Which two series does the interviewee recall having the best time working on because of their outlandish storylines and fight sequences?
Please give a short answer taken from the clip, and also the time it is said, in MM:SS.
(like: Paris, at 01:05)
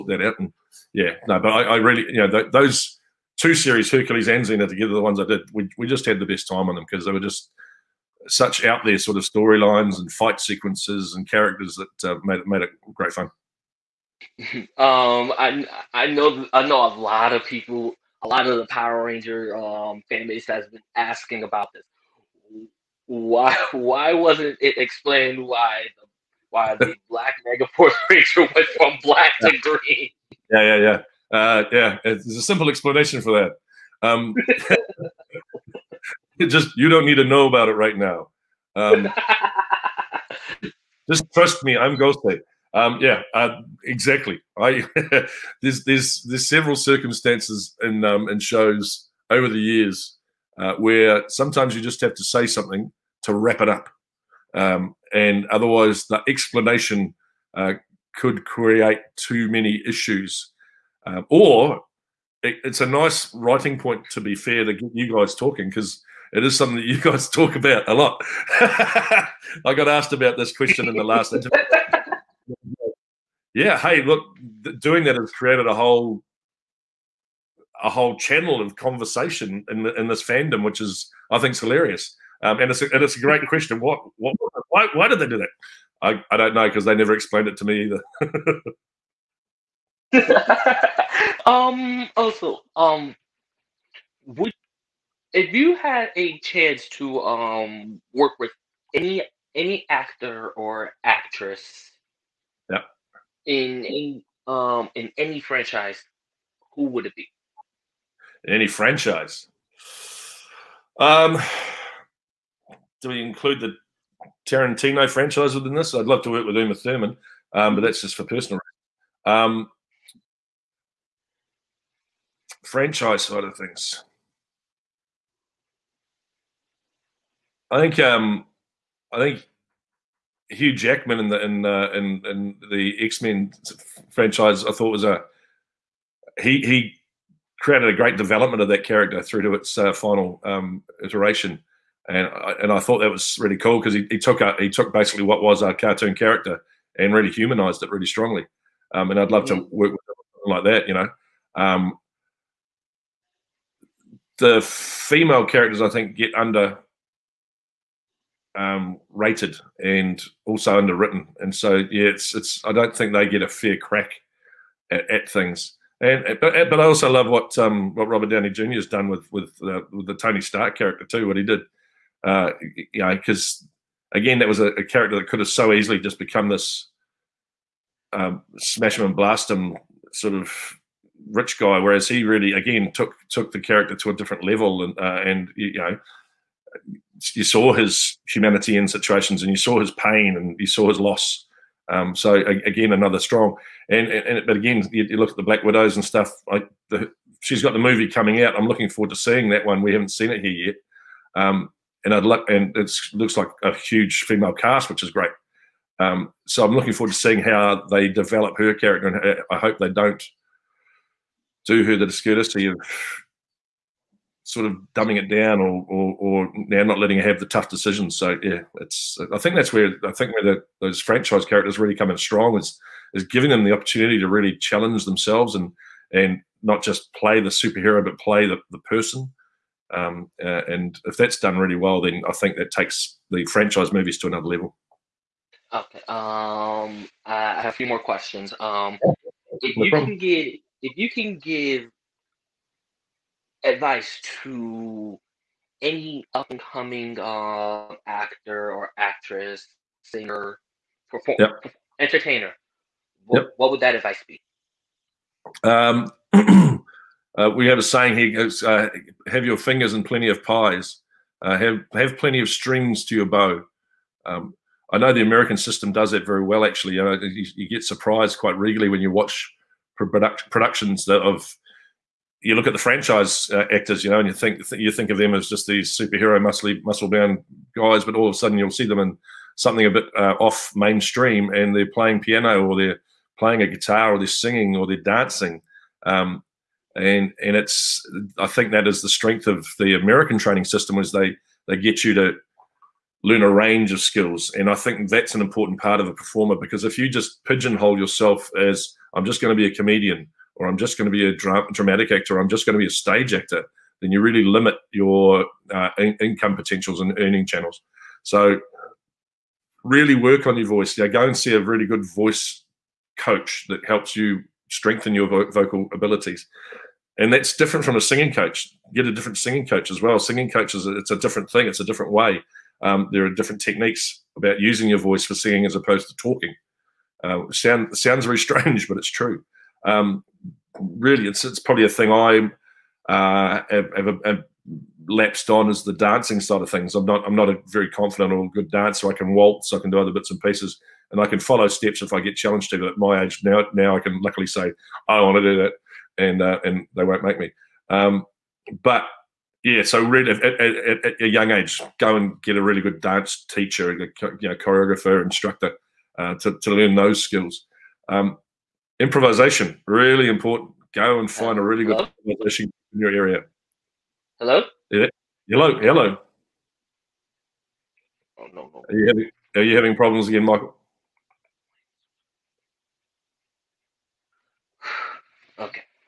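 Hercules and Xena, at 00:03.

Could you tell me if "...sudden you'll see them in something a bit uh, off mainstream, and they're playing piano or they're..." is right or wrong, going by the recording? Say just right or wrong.
right.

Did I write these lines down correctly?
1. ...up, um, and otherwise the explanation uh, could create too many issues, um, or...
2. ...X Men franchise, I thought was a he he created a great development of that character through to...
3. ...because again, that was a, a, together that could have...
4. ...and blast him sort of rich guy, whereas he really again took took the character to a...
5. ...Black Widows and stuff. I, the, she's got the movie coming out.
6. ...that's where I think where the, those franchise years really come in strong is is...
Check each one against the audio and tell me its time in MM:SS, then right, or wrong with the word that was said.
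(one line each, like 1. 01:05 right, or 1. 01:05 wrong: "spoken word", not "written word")
1. 00:53 right
2. 02:13 right
3. 02:53 wrong: "character", not "together"
4. 02:59 right
5. 03:15 right
6. 03:39 wrong: "characters", not "years".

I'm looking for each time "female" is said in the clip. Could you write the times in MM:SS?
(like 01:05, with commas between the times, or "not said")
02:34, 03:24.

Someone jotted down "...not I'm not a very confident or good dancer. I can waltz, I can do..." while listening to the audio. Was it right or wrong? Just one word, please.
right.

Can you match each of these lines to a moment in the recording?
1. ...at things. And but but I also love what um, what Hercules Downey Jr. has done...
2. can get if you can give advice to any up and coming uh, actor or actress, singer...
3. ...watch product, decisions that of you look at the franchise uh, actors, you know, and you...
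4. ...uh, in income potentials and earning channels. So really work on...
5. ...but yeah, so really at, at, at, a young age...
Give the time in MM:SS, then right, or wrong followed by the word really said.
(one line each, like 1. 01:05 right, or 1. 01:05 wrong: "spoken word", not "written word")
1. 02:45 wrong: "Robert", not "Hercules"
2. 04:00 right
3. 04:29 wrong: "productions", not "decisions"
4. 05:05 right
5. 05:48 right.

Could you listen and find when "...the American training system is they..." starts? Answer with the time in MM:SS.
04:49.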